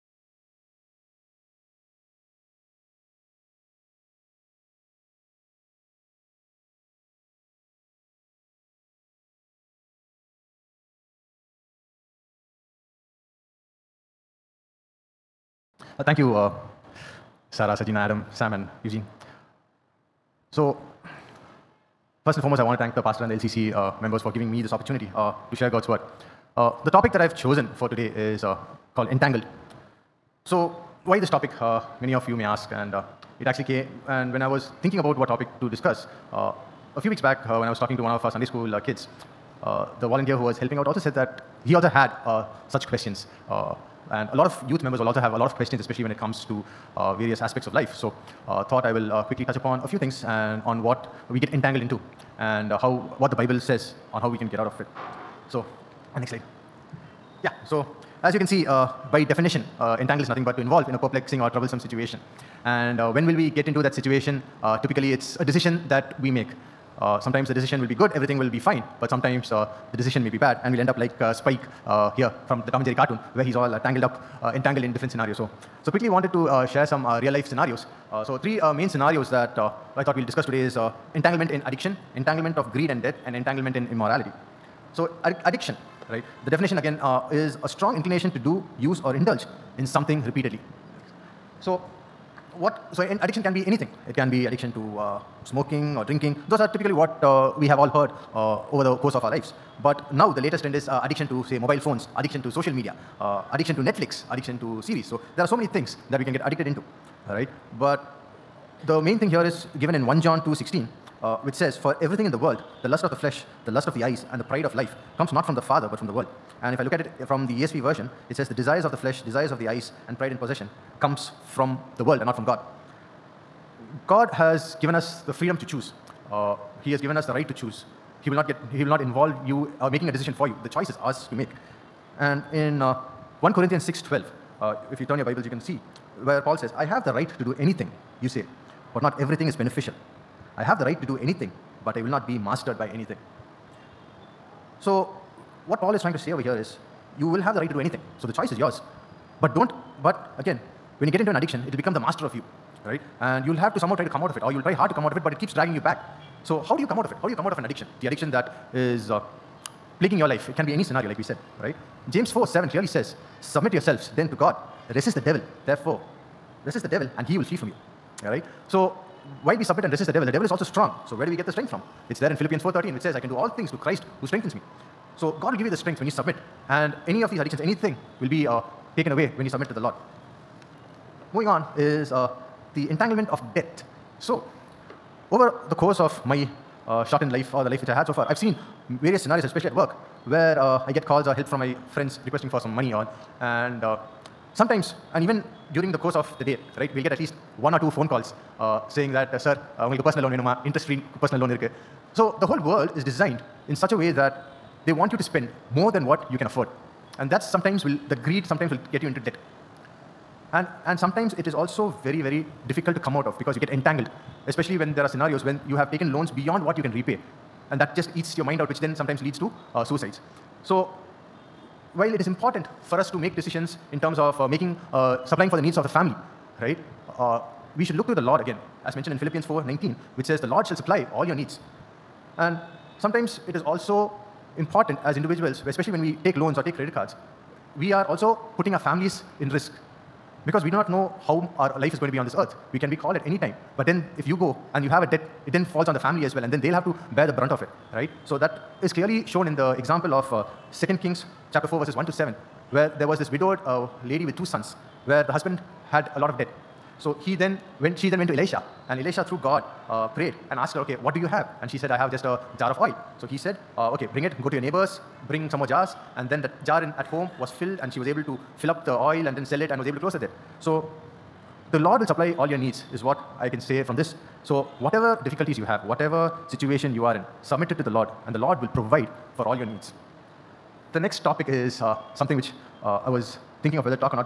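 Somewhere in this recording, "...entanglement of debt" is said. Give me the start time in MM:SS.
03:02.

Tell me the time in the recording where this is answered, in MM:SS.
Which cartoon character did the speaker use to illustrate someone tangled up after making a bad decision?
01:11.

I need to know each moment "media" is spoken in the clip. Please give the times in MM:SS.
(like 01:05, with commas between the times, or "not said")
01:42.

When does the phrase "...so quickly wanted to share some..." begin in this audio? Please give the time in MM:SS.
01:15.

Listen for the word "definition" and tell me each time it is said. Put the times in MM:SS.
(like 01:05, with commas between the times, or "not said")
00:59, 01:26.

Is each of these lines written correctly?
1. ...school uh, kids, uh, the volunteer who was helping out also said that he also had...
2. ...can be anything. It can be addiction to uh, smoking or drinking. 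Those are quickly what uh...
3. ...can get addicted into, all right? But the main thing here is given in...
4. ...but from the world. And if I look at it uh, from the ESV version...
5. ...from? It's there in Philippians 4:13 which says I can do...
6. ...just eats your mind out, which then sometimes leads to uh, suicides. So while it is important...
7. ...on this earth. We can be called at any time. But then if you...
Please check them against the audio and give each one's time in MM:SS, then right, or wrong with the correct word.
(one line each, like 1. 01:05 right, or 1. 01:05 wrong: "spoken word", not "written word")
1. 00:38 right
2. 01:33 wrong: "typically", not "quickly"
3. 01:46 right
4. 01:55 right
5. 02:51 right
6. 03:37 right
7. 04:02 right.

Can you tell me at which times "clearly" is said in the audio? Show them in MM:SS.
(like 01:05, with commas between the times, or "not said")
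02:42, 04:08.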